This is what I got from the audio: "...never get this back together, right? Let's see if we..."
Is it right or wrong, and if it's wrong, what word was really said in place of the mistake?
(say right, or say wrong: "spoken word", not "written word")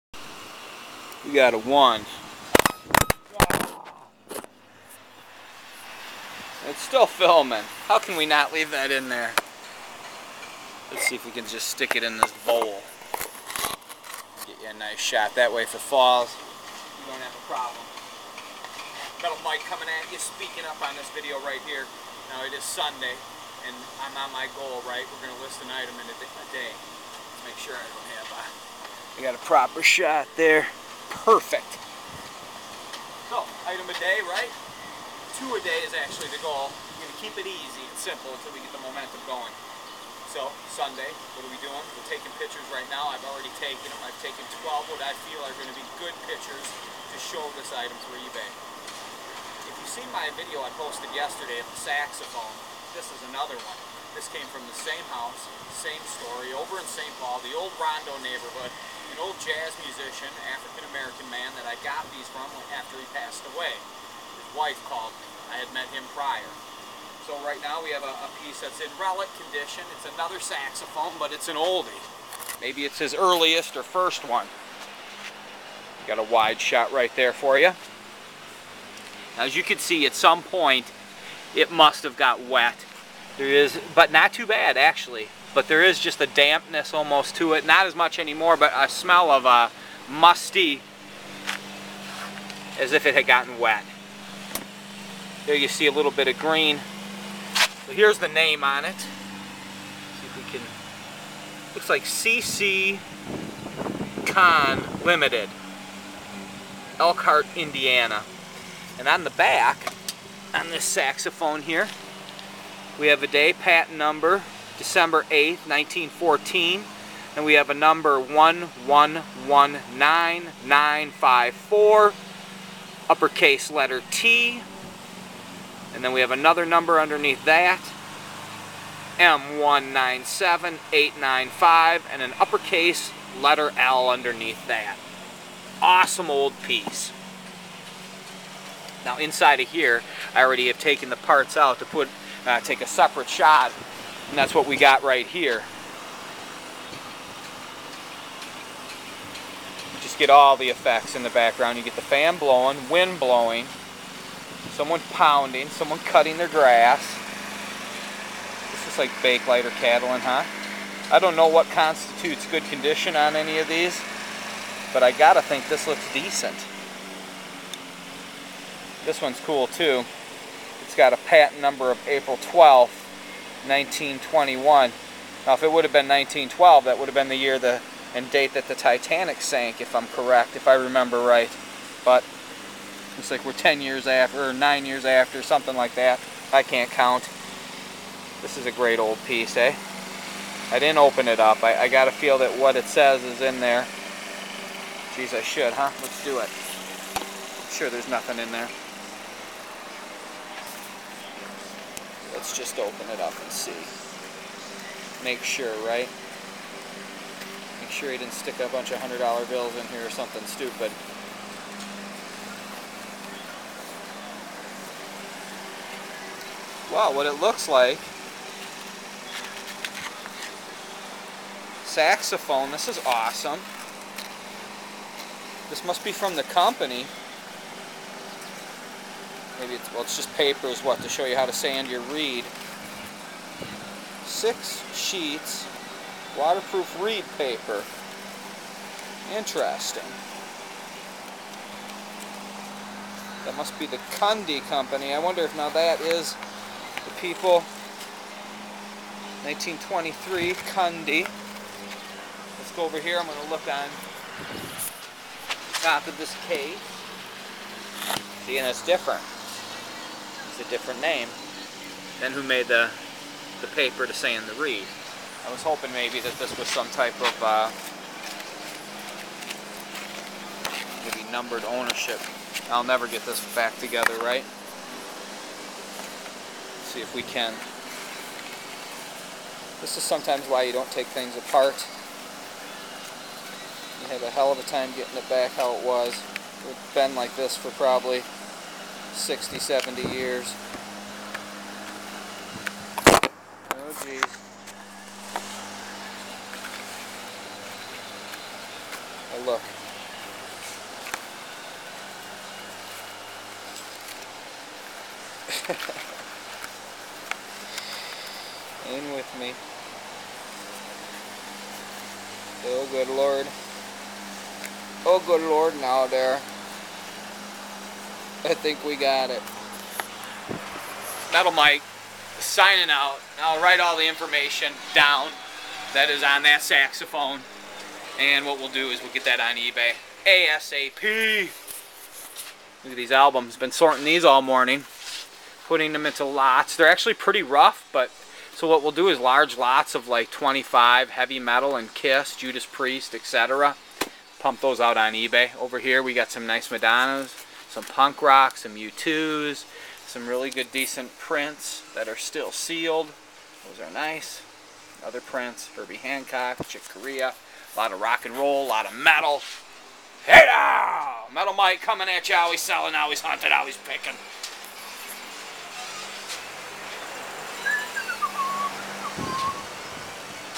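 right.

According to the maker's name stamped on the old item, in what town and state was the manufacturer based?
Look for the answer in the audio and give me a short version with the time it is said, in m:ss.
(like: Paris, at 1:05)
Elkhart, Indiana, at 1:46.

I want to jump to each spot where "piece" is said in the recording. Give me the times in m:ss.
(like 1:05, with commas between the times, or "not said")
1:08, 2:16, 3:09.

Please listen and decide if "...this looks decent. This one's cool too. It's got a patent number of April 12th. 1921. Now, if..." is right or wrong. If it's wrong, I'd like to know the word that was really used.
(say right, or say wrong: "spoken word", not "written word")
right.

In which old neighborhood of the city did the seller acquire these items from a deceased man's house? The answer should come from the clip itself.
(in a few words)
Rondo.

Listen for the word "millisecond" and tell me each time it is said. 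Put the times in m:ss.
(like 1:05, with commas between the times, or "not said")
not said.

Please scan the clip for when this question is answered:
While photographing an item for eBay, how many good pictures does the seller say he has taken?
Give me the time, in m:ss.
0:44.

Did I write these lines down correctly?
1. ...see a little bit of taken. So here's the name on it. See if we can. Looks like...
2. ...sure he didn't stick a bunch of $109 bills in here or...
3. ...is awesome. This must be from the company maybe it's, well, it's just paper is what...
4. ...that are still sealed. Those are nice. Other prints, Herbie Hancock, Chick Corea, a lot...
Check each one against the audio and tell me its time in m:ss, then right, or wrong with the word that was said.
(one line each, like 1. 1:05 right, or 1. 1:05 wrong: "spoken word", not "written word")
1. 1:35 wrong: "green", not "taken"
2. 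3:27 wrong: "100", not "109"
3. 3:42 right
4. 5:51 right.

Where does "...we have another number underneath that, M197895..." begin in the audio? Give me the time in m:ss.
2:06.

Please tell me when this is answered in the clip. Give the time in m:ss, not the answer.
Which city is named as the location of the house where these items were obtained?
0:56.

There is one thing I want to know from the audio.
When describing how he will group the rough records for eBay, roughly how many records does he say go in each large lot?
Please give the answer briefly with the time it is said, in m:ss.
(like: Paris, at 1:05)
25, at 5:40.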